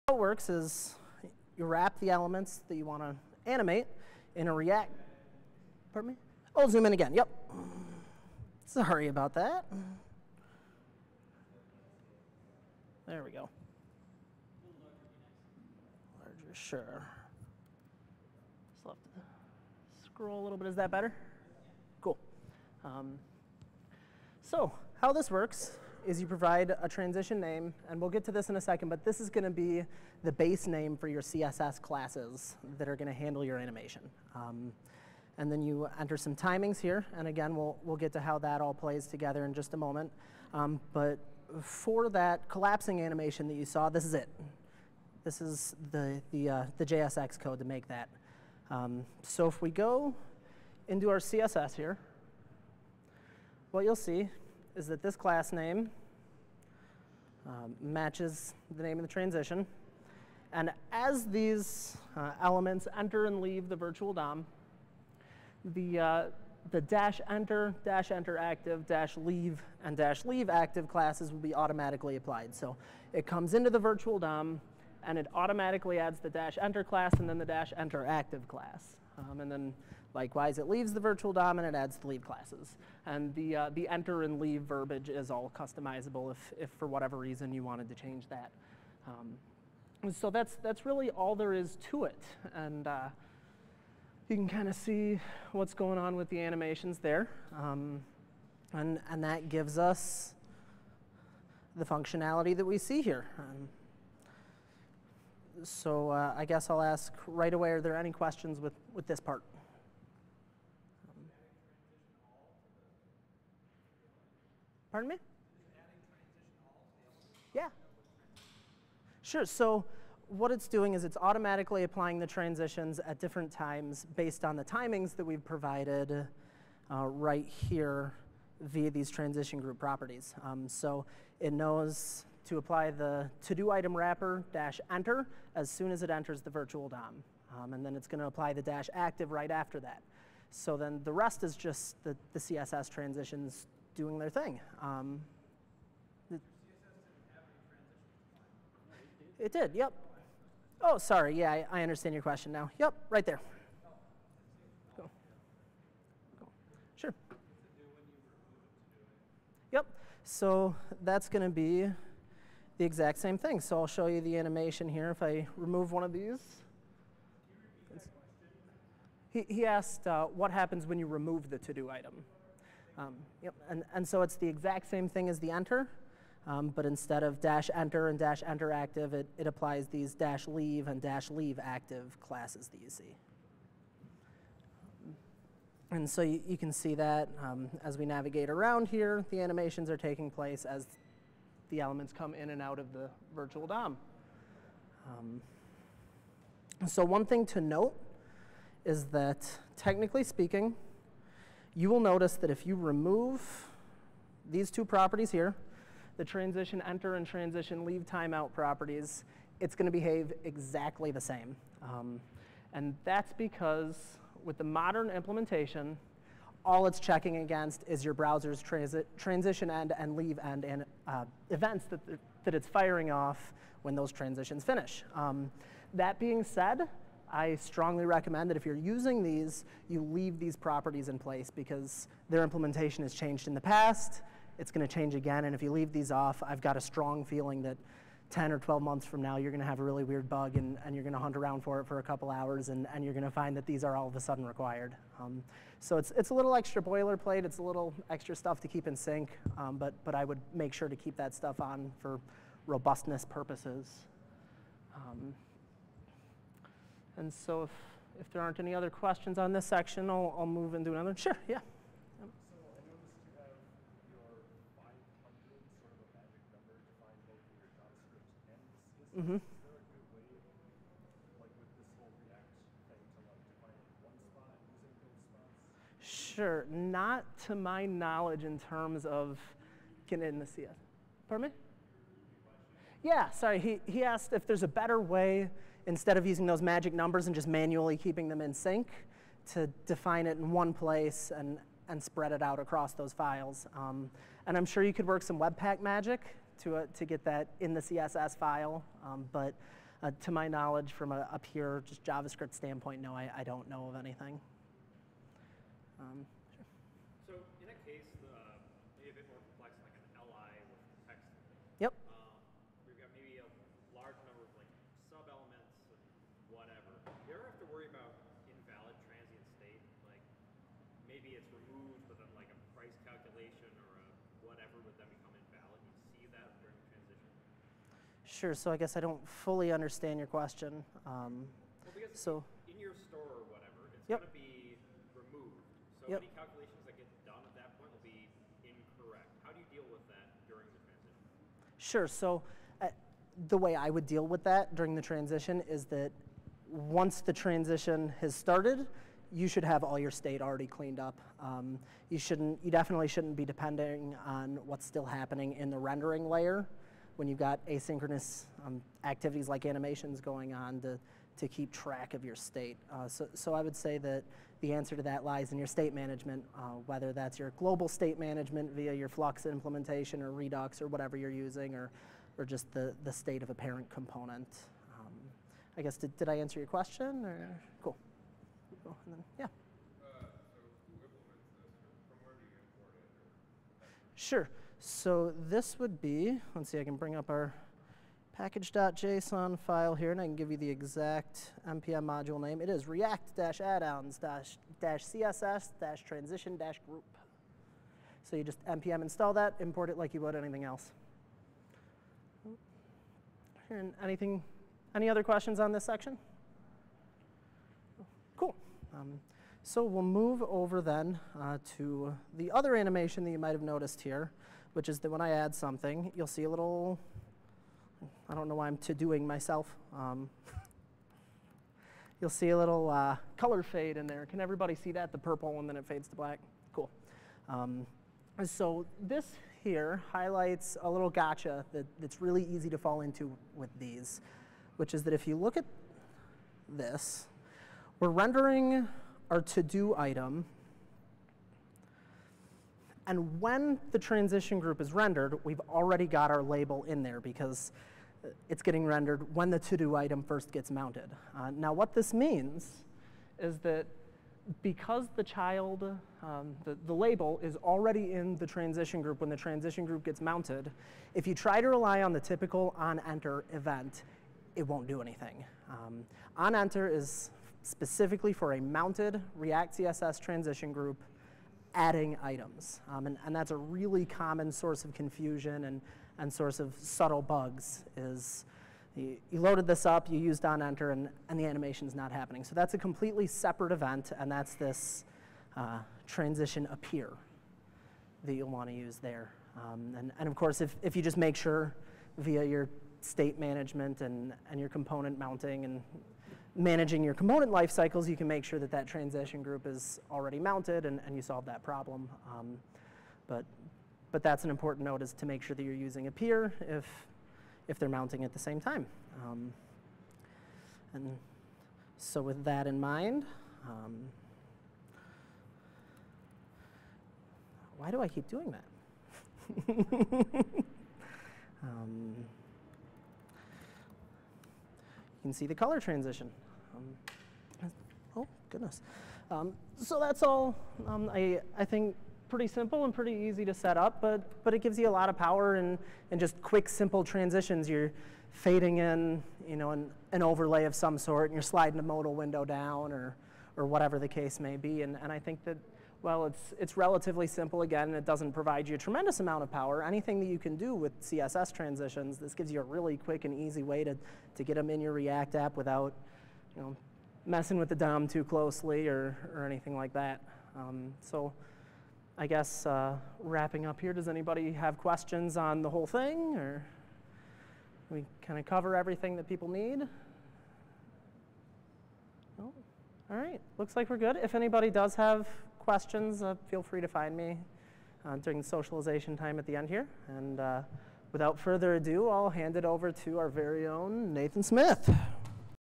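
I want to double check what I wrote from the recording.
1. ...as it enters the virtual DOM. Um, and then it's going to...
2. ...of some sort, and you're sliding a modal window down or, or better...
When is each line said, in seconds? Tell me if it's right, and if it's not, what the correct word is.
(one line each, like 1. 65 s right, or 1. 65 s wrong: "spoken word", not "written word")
1. 135 s right
2. 540 s wrong: "whatever", not "better".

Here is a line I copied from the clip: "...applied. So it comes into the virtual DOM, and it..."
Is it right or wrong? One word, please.
right.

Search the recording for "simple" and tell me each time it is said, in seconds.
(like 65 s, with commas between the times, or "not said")
532 s, 536 s, 547 s.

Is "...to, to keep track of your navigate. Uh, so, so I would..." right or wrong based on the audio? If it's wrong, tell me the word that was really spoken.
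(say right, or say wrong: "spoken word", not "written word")
wrong: "state", not "navigate".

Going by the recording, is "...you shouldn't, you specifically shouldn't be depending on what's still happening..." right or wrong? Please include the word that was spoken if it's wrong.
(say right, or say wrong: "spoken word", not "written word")
wrong: "definitely", not "specifically".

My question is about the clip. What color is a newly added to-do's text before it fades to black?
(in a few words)
Purple.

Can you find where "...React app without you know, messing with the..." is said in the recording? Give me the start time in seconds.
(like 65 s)
554 s.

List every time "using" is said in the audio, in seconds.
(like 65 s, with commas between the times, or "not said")
228 s, 286 s, 371 s, 505 s.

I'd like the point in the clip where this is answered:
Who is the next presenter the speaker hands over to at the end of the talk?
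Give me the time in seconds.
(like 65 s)
584 s.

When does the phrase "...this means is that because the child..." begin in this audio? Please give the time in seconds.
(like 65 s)
451 s.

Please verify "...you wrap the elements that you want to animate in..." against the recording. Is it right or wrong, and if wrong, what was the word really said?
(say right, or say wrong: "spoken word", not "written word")
right.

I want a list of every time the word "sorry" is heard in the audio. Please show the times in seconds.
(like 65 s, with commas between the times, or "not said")
8 s, 150 s.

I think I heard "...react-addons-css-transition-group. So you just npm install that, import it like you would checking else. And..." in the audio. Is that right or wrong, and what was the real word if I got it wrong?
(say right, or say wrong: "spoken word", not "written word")
wrong: "anything", not "checking".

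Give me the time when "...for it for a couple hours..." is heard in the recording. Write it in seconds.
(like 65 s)
241 s.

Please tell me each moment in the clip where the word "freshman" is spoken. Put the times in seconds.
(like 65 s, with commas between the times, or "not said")
not said.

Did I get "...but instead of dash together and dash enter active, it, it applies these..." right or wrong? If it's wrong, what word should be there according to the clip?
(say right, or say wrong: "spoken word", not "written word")
wrong: "enter", not "together".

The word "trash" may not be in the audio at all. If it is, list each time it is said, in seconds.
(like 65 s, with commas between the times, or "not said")
not said.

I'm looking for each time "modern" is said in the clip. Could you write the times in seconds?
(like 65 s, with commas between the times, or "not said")
214 s.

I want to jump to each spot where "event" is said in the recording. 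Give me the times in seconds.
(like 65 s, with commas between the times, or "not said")
221 s, 463 s, 483 s.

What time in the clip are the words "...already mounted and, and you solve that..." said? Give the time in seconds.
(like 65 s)
500 s.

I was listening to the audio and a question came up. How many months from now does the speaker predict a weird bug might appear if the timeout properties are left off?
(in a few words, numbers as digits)
10 or 12.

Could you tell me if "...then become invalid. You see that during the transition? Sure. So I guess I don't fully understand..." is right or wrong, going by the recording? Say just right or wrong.
right.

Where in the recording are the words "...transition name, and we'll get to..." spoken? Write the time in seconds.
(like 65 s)
26 s.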